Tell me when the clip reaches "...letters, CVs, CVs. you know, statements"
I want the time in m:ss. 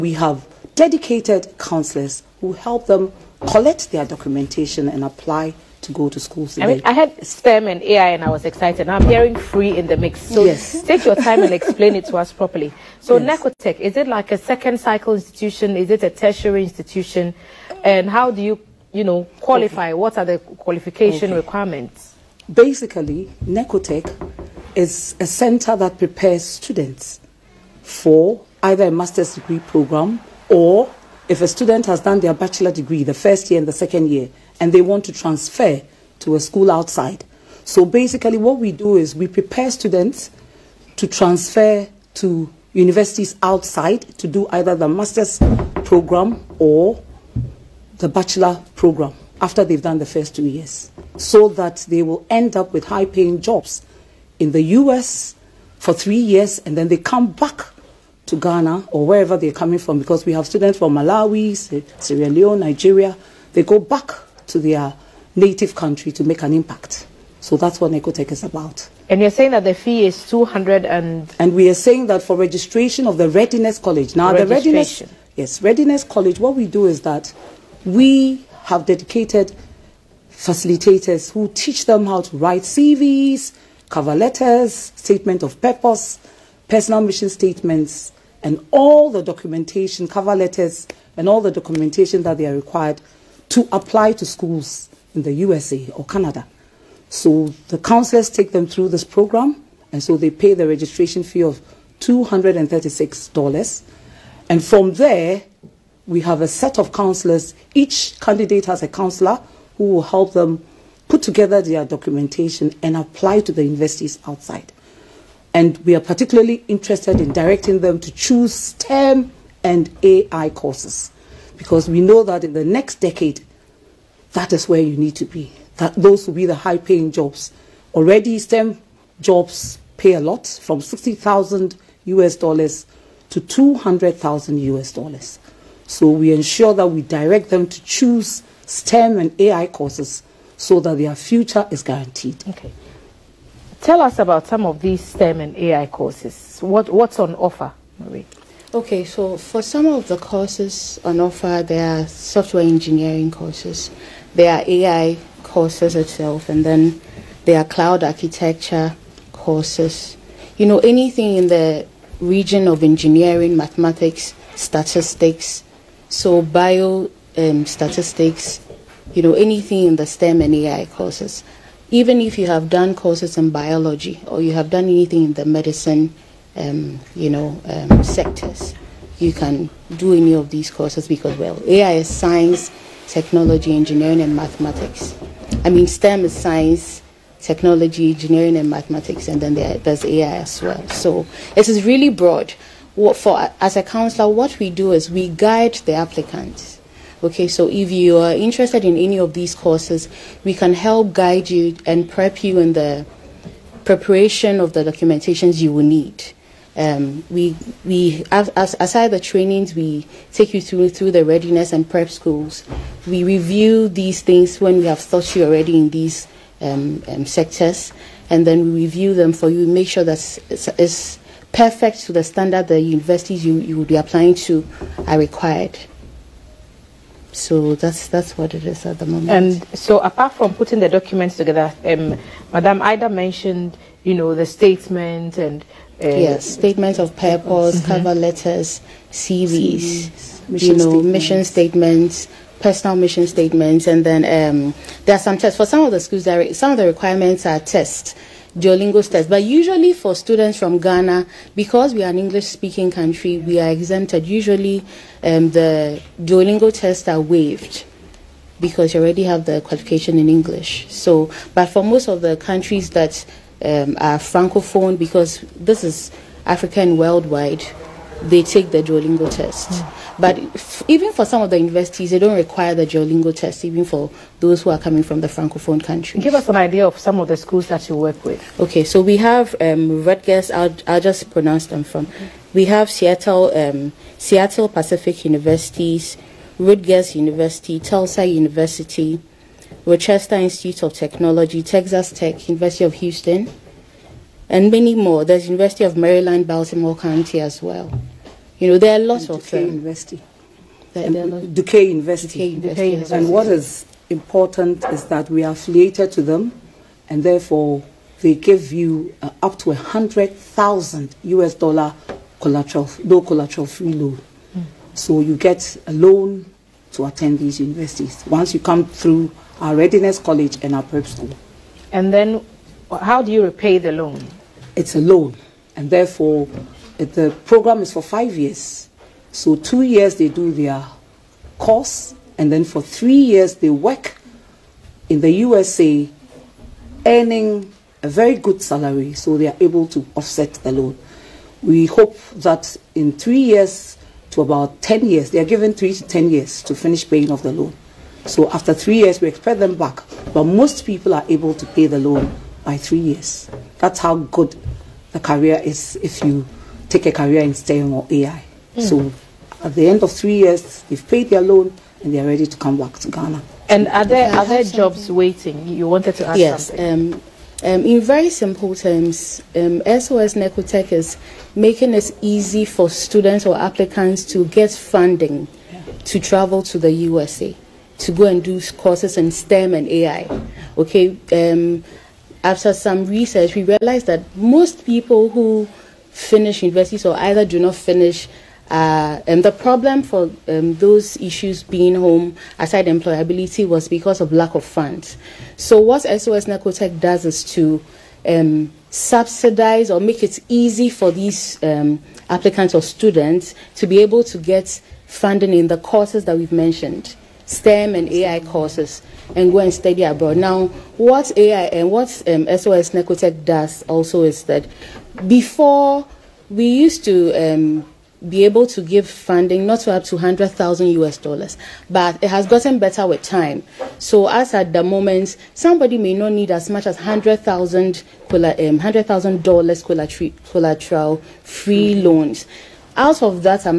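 3:58.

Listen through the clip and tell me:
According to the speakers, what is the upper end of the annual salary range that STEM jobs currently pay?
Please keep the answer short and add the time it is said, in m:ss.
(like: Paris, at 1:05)
200,000 US dollars, at 2:13.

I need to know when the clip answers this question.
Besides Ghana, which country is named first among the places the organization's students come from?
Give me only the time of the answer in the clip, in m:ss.
1:00.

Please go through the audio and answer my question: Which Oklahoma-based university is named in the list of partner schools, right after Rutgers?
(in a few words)
Tulsa University.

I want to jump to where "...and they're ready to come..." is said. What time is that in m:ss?
6:02.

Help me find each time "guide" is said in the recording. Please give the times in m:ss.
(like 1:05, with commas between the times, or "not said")
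3:15, 3:21.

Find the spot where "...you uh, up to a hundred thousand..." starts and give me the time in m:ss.
5:08.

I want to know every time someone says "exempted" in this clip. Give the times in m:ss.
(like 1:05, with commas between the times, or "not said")
4:13.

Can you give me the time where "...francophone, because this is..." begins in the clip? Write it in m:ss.
4:24.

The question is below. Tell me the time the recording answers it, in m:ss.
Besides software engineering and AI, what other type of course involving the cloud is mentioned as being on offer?
2:37.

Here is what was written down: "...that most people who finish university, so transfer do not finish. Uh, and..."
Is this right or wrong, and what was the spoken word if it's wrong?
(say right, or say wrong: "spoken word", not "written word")
wrong: "either", not "transfer".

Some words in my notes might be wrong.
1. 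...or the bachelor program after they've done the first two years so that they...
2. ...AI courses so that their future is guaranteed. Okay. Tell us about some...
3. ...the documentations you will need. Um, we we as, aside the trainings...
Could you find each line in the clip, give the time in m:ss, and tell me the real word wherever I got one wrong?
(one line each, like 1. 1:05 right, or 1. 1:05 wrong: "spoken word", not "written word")
1. 0:46 right
2. 2:19 right
3. 3:24 right.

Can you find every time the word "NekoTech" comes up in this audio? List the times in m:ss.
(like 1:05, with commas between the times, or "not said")
0:13, 0:23, 1:07, 6:10, 6:36, 6:52.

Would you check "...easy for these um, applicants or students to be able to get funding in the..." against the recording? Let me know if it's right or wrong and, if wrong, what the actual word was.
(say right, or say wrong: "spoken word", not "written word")
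right.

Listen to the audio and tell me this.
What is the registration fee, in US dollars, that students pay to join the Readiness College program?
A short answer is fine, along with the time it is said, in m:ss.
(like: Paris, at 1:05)
$236, at 1:41.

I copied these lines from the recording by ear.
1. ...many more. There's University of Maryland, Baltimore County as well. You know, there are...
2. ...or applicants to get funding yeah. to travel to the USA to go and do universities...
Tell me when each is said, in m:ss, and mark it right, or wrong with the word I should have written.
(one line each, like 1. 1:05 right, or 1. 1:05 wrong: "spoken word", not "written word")
1. 4:54 right
2. 6:13 wrong: "courses", not "universities".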